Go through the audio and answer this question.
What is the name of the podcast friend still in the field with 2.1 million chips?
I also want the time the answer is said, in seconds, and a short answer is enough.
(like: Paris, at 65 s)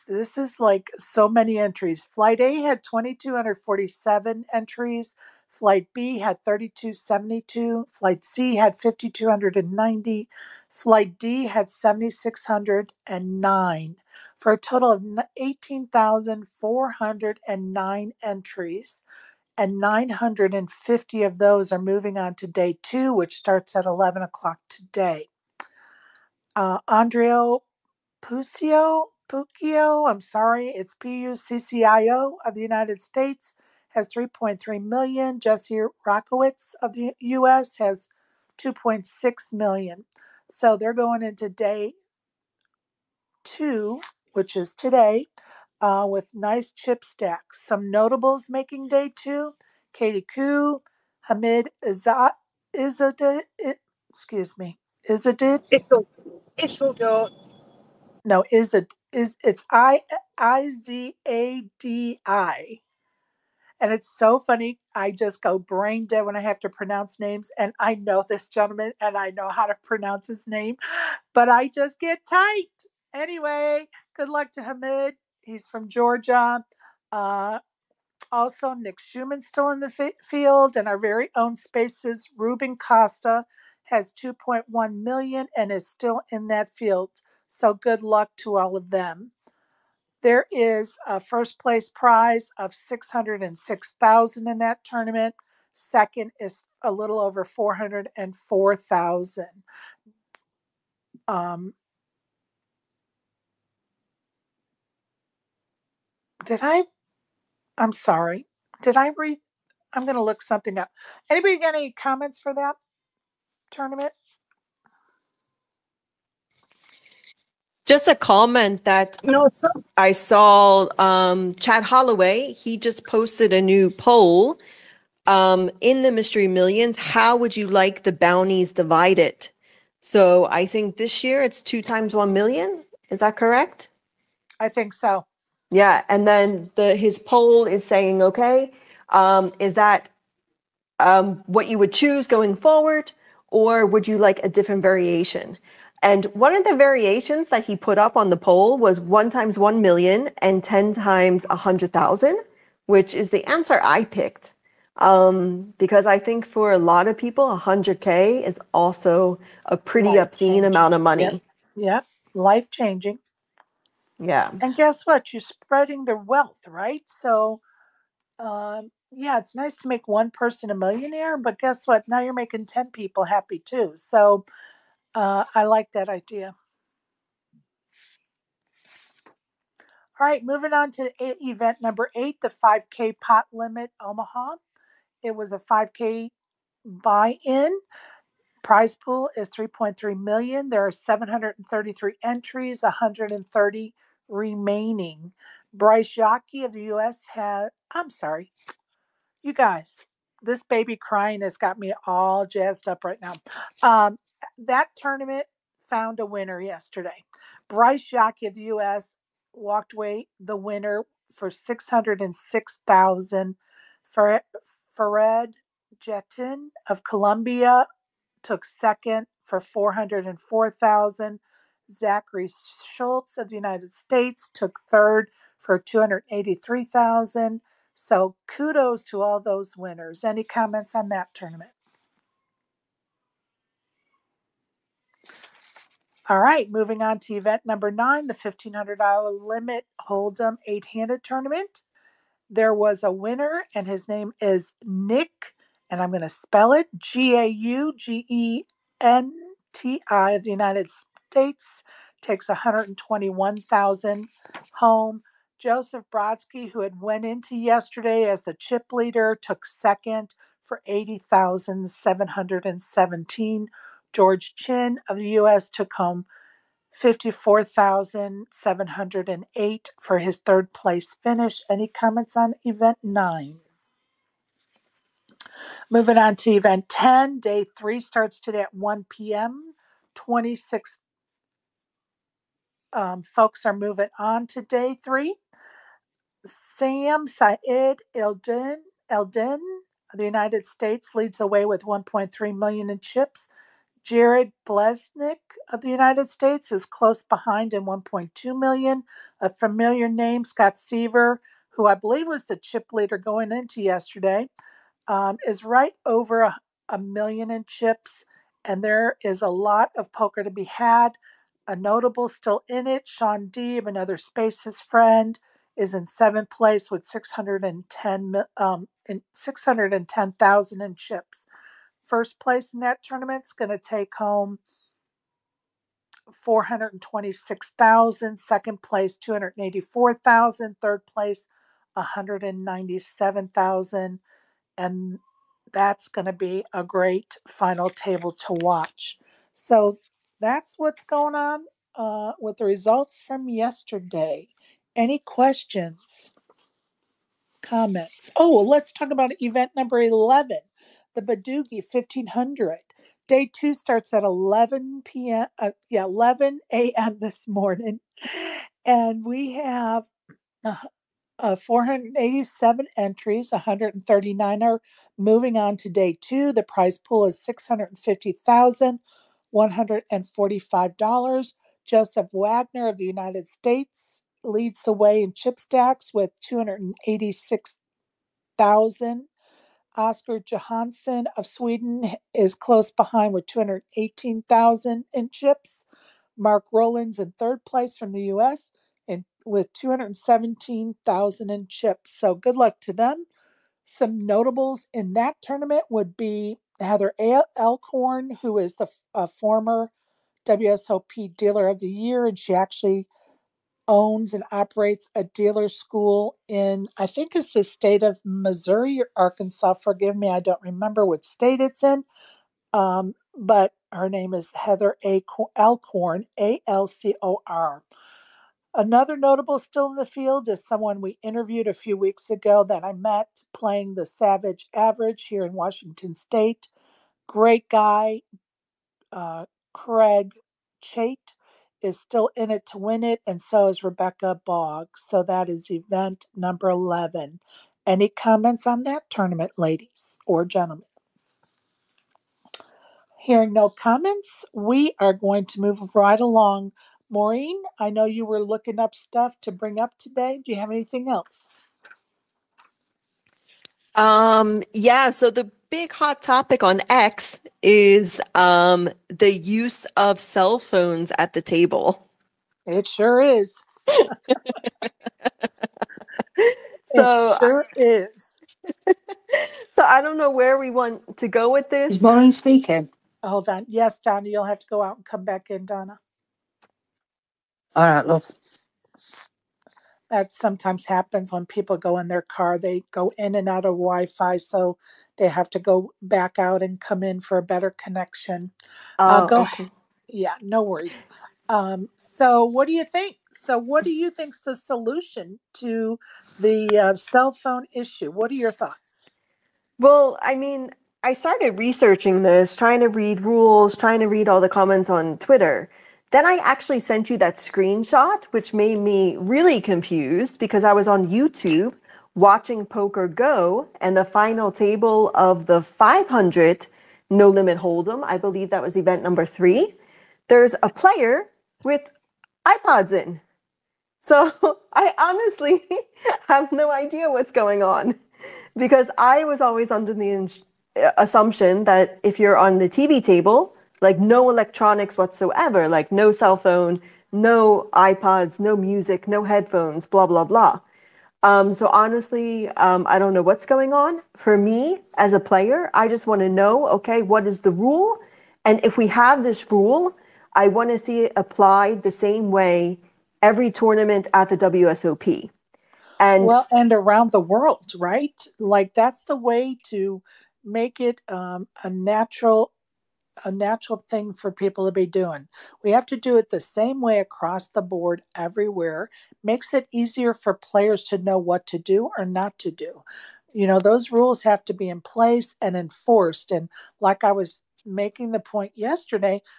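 Ruben Costa, at 82 s.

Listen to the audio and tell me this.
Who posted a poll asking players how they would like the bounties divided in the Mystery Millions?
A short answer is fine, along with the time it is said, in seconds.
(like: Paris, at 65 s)
Chad Holloway, at 121 s.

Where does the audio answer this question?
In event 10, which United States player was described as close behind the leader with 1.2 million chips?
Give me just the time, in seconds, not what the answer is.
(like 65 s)
294 s.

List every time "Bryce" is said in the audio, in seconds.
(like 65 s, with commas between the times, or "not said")
195 s, 207 s.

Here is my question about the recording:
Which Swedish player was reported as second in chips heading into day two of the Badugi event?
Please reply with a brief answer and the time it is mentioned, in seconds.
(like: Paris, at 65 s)
Oscar Johansson, at 379 s.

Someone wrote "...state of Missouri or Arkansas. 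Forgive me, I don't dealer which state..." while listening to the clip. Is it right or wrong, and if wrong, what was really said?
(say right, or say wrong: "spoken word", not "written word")
wrong: "remember", not "dealer".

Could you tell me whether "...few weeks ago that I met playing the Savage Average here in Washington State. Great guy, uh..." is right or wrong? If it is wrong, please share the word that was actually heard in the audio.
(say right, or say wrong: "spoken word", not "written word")
right.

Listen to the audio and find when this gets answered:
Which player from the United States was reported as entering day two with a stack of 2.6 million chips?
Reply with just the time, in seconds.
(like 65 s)
35 s.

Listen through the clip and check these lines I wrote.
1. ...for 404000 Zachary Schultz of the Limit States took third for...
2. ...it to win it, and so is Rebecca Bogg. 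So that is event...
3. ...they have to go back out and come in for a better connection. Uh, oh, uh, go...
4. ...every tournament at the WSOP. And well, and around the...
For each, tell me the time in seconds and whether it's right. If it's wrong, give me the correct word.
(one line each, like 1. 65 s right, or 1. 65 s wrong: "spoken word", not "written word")
1. 219 s wrong: "United", not "Limit"
2. 432 s right
3. 485 s right
4. 553 s right.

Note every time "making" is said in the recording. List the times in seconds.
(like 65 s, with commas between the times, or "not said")
48 s, 172 s, 577 s.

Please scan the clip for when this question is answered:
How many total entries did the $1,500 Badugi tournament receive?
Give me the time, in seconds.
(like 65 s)
361 s.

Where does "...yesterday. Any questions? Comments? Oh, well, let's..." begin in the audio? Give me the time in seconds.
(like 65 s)
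343 s.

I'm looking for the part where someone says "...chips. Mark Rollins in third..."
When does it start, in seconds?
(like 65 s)
385 s.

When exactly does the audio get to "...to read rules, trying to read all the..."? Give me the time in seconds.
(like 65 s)
502 s.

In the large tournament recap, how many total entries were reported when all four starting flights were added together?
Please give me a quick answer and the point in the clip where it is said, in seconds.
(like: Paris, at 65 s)
18,409, at 15 s.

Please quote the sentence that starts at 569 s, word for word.
Makes it easier for players to know what to do or not to do.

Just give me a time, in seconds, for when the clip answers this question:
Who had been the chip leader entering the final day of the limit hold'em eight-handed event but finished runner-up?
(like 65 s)
255 s.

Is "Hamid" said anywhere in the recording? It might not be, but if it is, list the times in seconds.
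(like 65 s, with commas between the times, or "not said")
51 s, 74 s.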